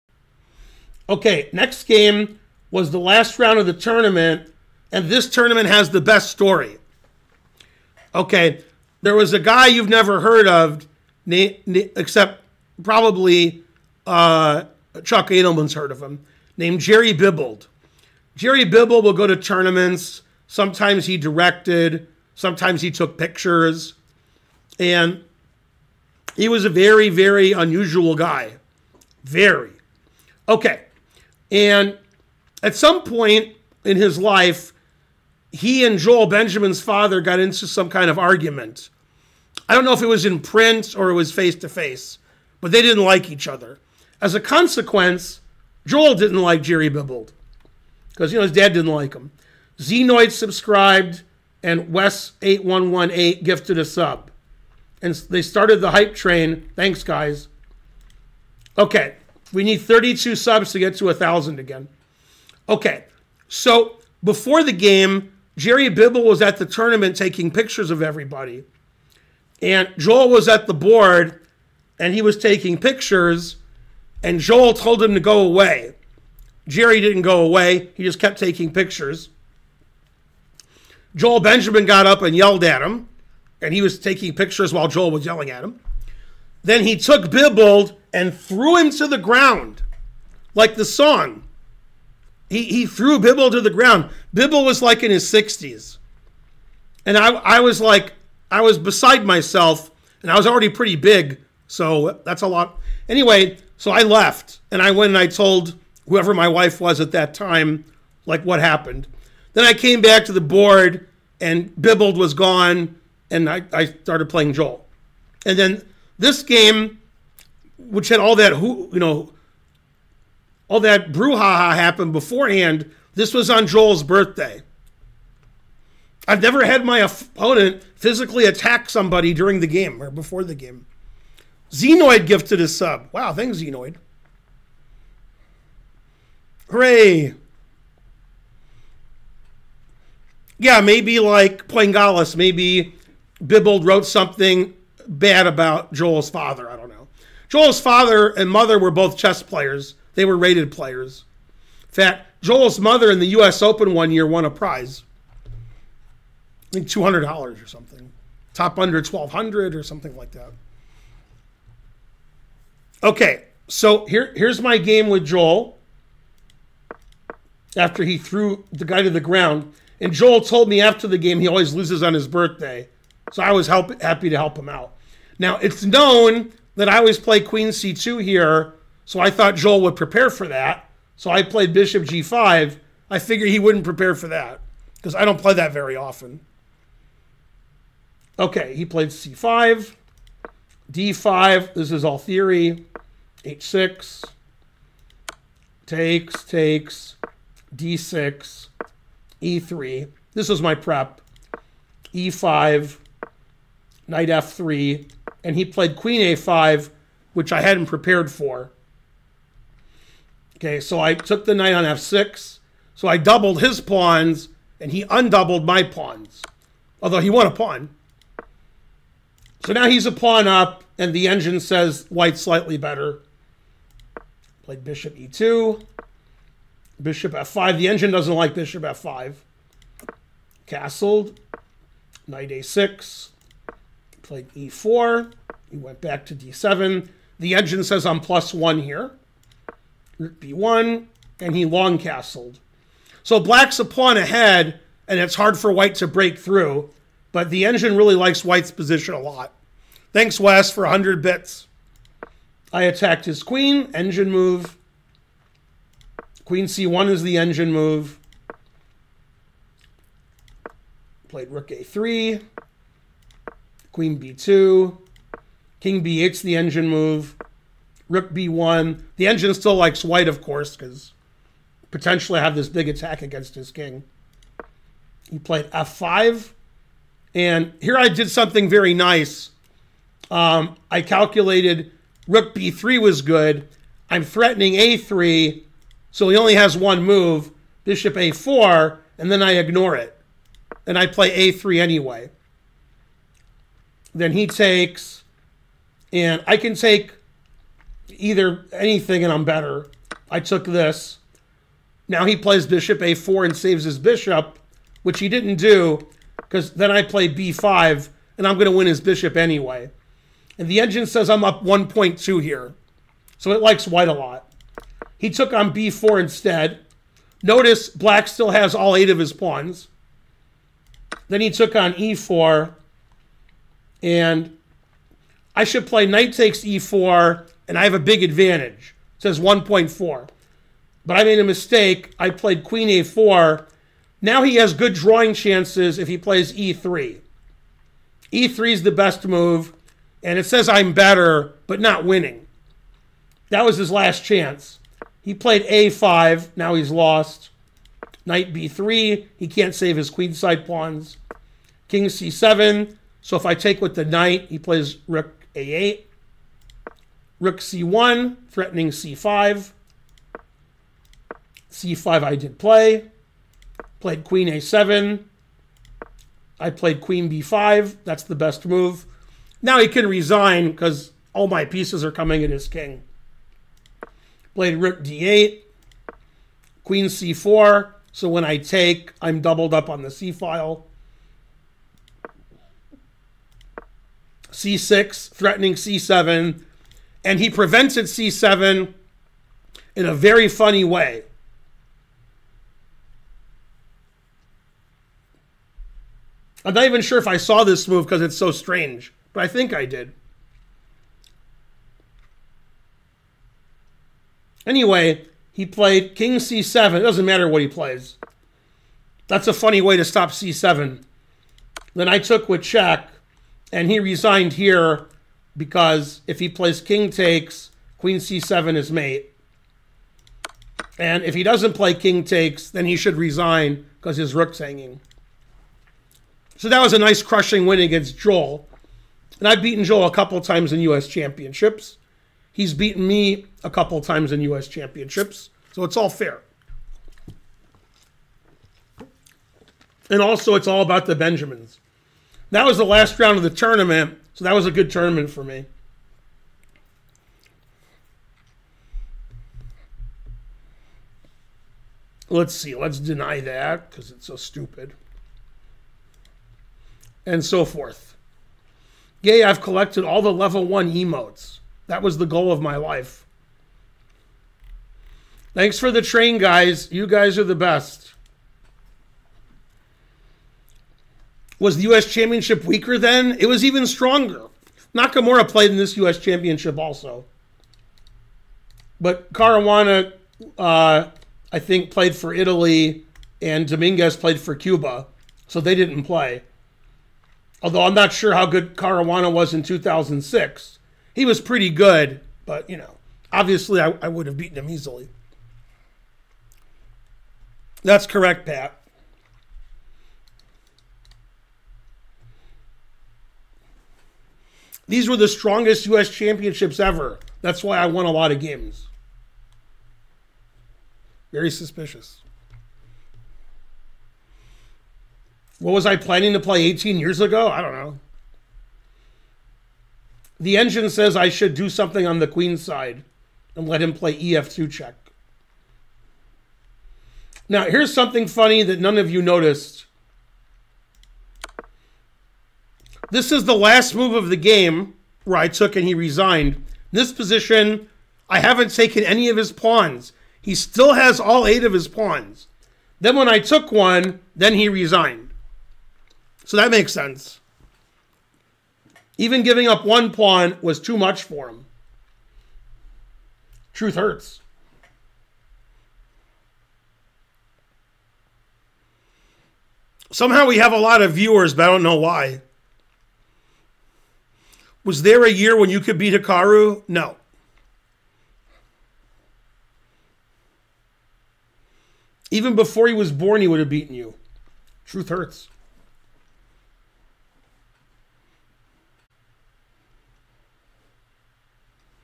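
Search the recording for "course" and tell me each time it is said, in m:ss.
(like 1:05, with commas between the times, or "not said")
4:30.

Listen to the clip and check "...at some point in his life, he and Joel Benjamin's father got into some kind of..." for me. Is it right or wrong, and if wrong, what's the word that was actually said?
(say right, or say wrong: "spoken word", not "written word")
right.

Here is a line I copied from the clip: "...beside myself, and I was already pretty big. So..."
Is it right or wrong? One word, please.
right.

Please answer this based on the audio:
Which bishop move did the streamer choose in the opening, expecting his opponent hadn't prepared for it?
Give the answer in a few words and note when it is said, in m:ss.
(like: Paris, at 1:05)
bishop g5, at 3:01.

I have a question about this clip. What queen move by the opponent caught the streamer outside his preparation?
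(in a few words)
queen a5.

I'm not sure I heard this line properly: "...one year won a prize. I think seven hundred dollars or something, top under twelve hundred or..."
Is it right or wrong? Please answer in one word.
wrong.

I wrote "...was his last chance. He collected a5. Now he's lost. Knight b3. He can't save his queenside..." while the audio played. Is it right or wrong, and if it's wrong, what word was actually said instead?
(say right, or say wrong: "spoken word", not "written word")
wrong: "played", not "collected".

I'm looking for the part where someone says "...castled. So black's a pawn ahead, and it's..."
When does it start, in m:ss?
4:01.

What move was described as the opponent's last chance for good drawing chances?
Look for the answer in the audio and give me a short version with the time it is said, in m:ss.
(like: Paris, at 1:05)
e3, at 5:38.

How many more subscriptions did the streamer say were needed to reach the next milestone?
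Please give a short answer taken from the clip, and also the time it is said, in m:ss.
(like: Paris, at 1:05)
32, at 0:59.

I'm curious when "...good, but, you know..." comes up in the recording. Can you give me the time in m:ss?
8:11.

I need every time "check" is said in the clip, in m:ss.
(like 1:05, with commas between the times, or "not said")
6:52, 8:44.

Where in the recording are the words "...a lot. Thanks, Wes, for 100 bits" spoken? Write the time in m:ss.
4:09.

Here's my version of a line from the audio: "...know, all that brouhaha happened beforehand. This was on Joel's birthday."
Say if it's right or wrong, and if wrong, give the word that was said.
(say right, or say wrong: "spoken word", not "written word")
right.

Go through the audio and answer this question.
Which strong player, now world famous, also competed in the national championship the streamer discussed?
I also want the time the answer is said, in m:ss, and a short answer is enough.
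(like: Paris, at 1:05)
Nakamura, at 7:54.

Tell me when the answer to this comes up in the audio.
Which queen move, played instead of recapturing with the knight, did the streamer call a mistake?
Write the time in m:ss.
5:32.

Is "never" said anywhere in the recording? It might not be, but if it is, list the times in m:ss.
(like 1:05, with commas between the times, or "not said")
0:09, 2:06.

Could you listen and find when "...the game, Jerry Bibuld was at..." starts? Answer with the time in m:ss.
1:04.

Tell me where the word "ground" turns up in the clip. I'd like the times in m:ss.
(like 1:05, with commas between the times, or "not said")
1:29, 1:33, 2:49.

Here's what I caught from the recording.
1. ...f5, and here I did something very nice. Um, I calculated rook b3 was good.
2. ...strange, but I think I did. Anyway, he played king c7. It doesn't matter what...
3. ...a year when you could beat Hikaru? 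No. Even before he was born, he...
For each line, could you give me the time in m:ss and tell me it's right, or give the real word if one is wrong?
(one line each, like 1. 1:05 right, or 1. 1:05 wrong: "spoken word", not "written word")
1. 4:35 right
2. 6:38 right
3. 9:25 right.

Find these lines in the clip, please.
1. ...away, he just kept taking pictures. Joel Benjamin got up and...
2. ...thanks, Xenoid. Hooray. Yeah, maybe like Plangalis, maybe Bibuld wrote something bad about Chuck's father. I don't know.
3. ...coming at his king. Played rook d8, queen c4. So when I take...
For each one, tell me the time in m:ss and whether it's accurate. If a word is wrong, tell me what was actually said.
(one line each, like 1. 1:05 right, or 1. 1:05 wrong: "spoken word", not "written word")
1. 1:17 right
2. 2:13 wrong: "Joel", not "Chuck"
3. 6:12 right.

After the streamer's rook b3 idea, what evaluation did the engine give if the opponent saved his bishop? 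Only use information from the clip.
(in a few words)
1.2.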